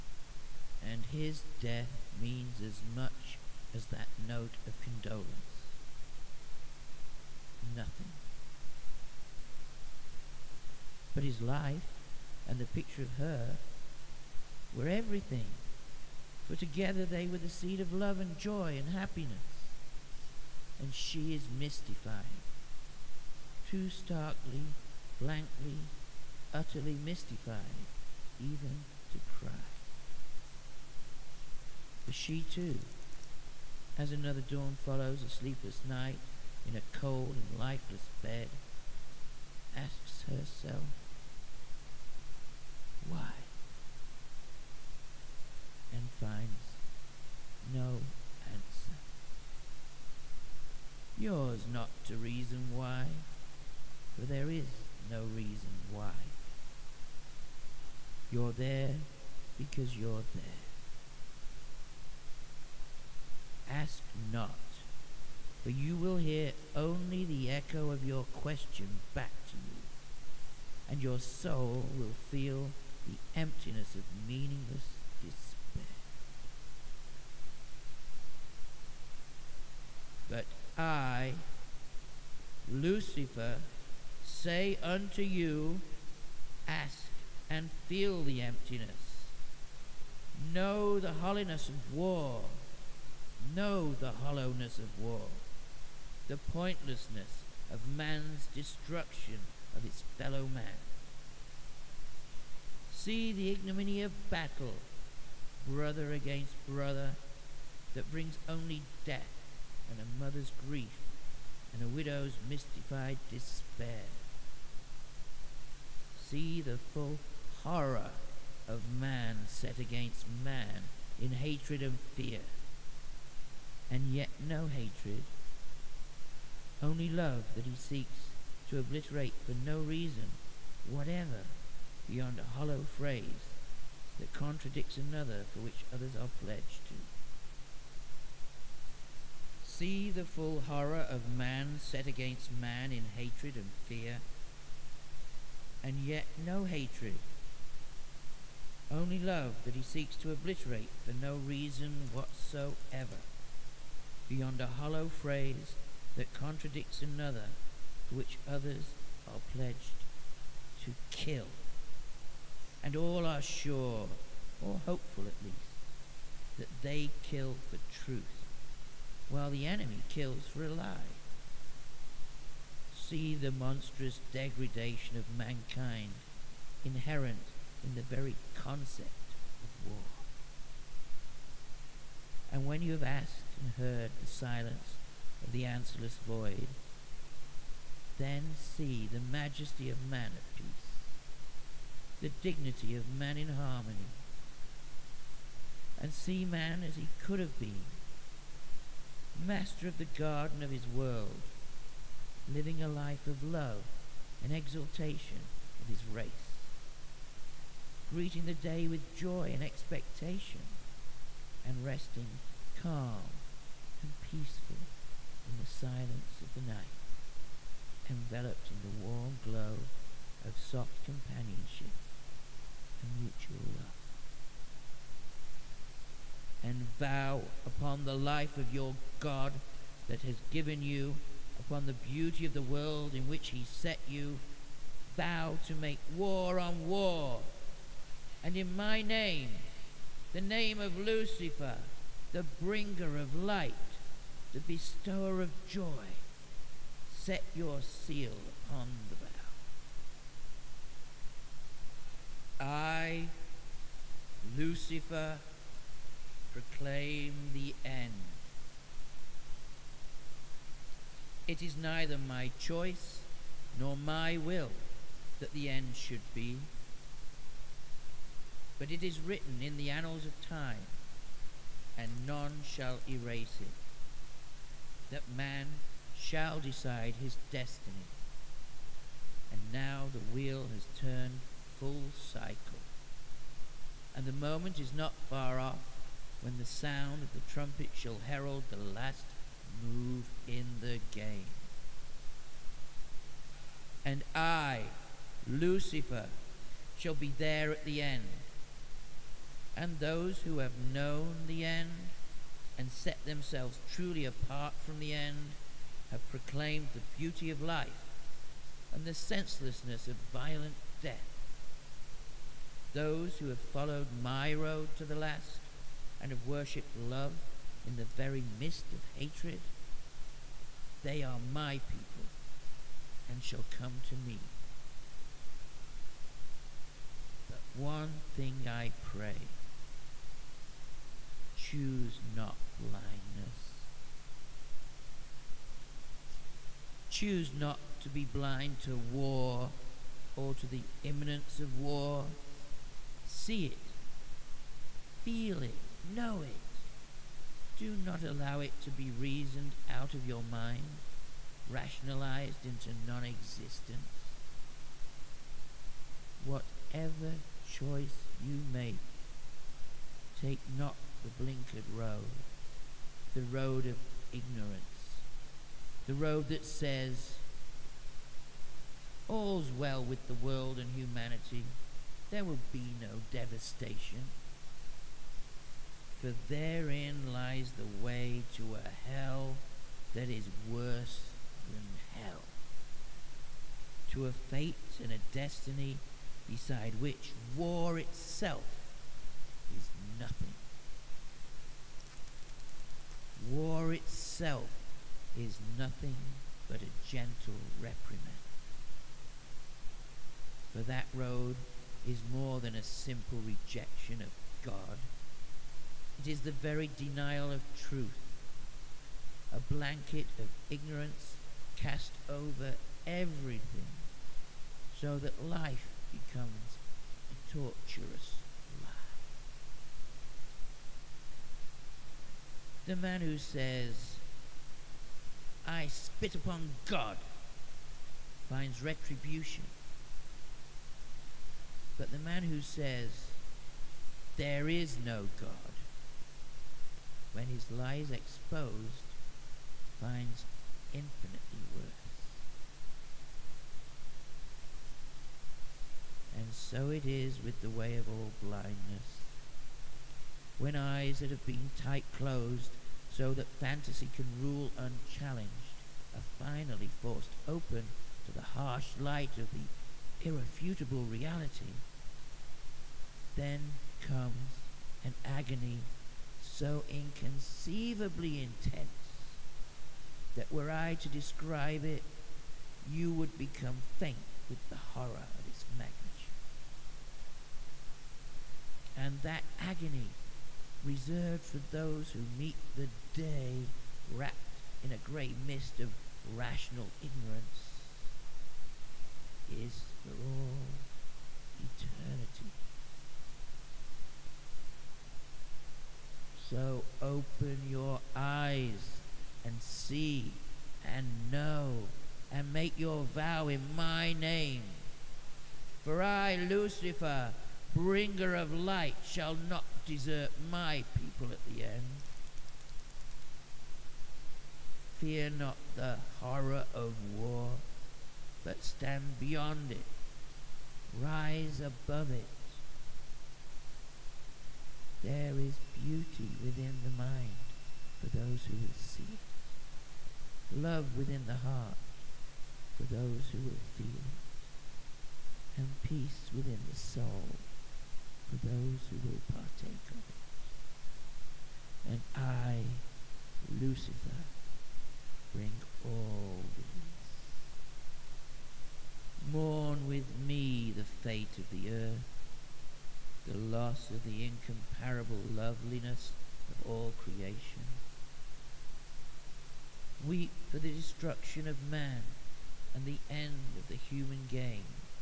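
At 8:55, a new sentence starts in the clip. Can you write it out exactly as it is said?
And peace within the soul for those who will partake of it.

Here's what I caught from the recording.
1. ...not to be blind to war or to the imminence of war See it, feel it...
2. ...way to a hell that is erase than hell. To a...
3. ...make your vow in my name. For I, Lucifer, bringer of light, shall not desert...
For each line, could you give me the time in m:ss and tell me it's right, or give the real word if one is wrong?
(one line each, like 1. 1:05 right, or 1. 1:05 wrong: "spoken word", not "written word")
1. 5:37 right
2. 6:18 wrong: "worse", not "erase"
3. 8:22 right.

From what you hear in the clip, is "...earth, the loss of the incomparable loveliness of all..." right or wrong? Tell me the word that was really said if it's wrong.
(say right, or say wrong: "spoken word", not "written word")
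right.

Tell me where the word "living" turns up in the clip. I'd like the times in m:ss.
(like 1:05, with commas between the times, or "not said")
3:22.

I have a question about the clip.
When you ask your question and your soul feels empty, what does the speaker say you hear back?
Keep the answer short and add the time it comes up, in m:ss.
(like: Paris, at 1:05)
The echo, at 1:07.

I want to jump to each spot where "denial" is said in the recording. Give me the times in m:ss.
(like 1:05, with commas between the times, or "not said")
6:46.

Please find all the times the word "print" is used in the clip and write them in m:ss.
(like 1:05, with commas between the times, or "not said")
not said.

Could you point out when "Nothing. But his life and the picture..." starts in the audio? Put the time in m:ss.
0:07.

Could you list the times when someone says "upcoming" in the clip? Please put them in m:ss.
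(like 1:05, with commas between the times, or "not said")
not said.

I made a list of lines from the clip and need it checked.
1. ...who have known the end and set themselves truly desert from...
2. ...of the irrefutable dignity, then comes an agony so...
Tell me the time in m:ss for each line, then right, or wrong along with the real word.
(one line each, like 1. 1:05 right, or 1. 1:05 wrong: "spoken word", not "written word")
1. 5:00 wrong: "apart", not "desert"
2. 7:39 wrong: "reality", not "dignity".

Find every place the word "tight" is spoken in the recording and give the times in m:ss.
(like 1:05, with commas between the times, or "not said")
7:31.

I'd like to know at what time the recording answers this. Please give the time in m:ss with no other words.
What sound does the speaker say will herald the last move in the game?
4:47.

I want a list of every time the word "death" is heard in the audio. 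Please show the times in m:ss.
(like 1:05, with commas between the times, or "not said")
0:01, 1:49, 5:11.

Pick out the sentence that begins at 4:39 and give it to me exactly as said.
And now the wheel has turned full cycle.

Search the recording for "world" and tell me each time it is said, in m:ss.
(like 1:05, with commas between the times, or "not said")
3:20, 3:52, 6:10.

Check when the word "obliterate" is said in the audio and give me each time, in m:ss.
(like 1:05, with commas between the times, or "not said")
2:08, 2:30.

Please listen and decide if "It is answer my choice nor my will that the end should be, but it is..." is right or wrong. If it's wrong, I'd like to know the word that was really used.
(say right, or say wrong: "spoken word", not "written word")
wrong: "neither", not "answer".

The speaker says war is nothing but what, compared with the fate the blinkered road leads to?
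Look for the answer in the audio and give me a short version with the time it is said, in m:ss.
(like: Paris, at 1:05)
A gentle reprimand, at 6:37.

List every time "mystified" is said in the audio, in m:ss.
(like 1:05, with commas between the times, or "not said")
0:21, 0:27, 1:52.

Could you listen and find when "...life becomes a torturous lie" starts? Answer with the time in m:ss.
6:55.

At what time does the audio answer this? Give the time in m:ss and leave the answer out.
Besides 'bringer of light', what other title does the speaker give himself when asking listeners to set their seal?
4:04.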